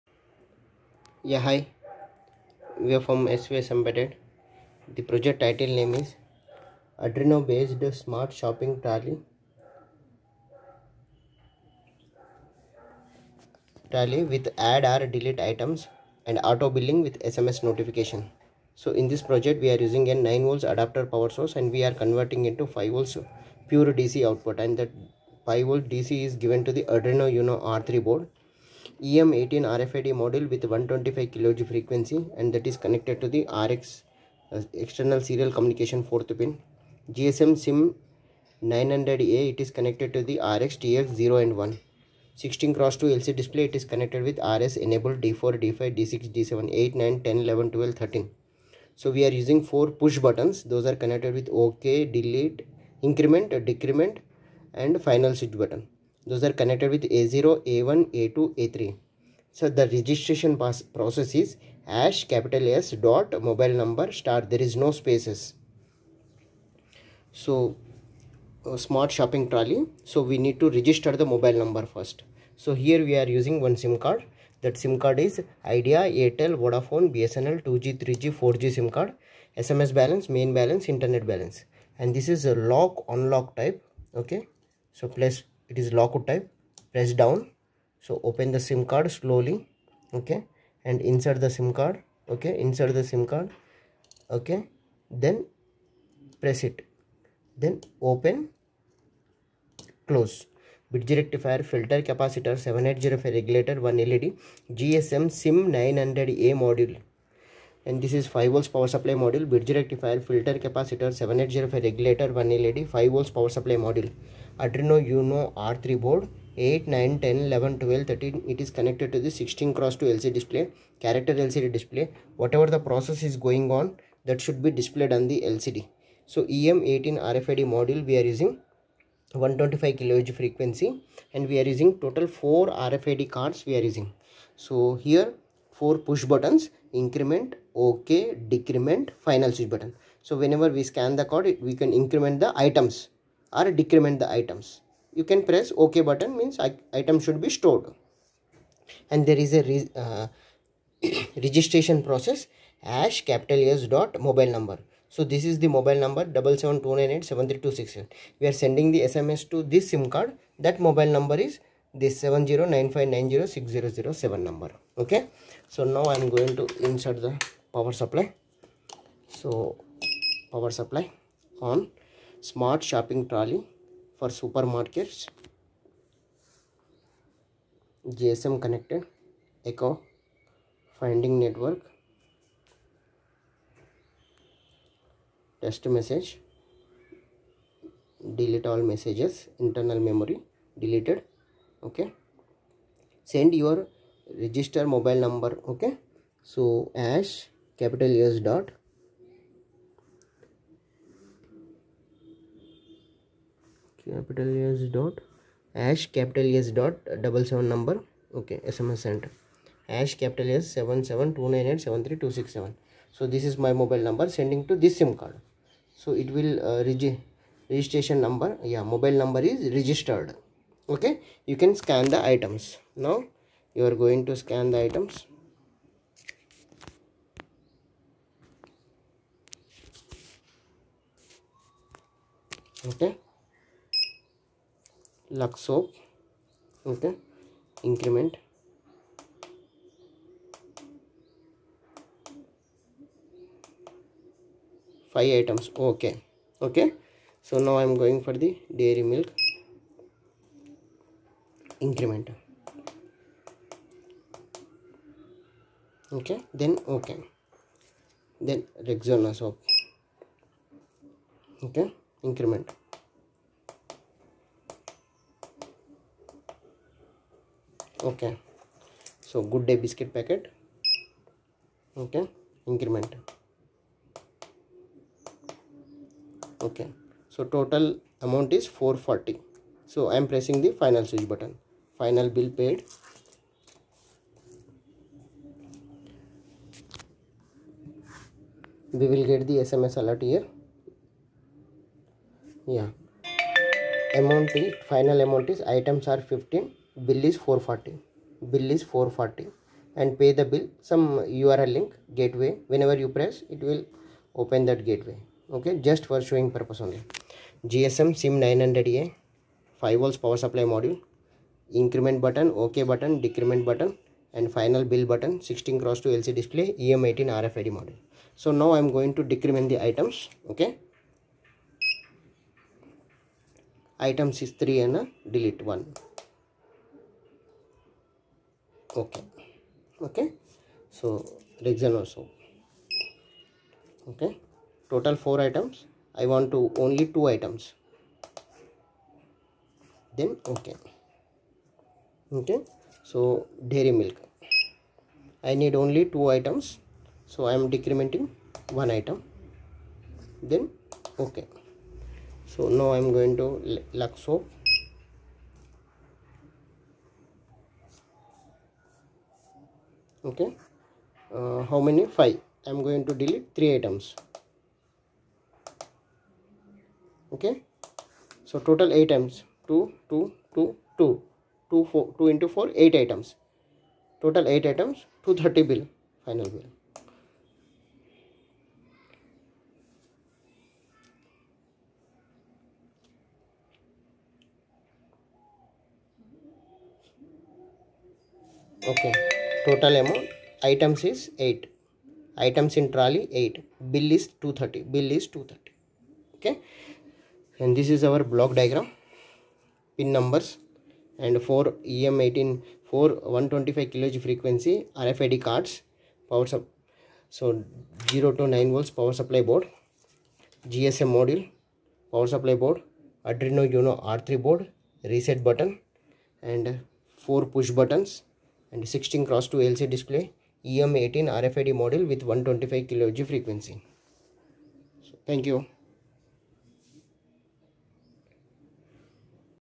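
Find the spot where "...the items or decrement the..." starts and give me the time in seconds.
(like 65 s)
142 s.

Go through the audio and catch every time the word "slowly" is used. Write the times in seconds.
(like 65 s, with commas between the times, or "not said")
89 s.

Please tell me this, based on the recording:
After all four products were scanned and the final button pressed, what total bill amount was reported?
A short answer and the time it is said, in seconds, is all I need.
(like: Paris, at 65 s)
440, at 297 s.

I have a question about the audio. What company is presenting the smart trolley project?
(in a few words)
SVS Embedded.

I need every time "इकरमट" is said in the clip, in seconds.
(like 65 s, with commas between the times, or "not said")
272 s.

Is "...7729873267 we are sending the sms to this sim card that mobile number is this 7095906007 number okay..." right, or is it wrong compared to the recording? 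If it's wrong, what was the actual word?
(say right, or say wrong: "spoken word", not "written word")
right.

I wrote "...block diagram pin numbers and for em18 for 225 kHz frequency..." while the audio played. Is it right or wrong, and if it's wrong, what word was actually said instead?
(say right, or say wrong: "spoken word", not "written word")
wrong: "125", not "225".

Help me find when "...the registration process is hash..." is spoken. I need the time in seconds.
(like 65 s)
59 s.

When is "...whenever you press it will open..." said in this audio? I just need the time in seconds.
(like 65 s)
302 s.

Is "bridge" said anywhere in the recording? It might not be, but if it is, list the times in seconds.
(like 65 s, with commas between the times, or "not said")
100 s, 109 s.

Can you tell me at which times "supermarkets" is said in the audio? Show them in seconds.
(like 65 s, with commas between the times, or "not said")
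174 s.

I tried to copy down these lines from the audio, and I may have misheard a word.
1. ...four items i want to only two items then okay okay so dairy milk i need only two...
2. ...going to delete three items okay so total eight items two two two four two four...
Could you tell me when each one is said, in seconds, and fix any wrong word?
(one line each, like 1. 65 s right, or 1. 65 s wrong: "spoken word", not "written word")
1. 335 s right
2. 362 s wrong: "two", not "four".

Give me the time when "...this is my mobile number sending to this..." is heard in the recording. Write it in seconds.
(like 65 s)
213 s.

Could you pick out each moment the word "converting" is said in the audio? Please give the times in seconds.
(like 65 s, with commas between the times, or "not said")
21 s.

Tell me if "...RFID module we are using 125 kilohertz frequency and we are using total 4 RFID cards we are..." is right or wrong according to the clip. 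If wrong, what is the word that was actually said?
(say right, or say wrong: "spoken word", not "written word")
right.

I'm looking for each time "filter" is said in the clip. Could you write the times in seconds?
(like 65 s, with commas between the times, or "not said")
101 s, 110 s.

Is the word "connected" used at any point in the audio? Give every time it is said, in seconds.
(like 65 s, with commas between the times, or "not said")
32 s, 39 s, 43 s, 50 s, 56 s, 118 s, 178 s.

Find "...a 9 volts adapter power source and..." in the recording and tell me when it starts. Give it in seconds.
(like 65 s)
20 s.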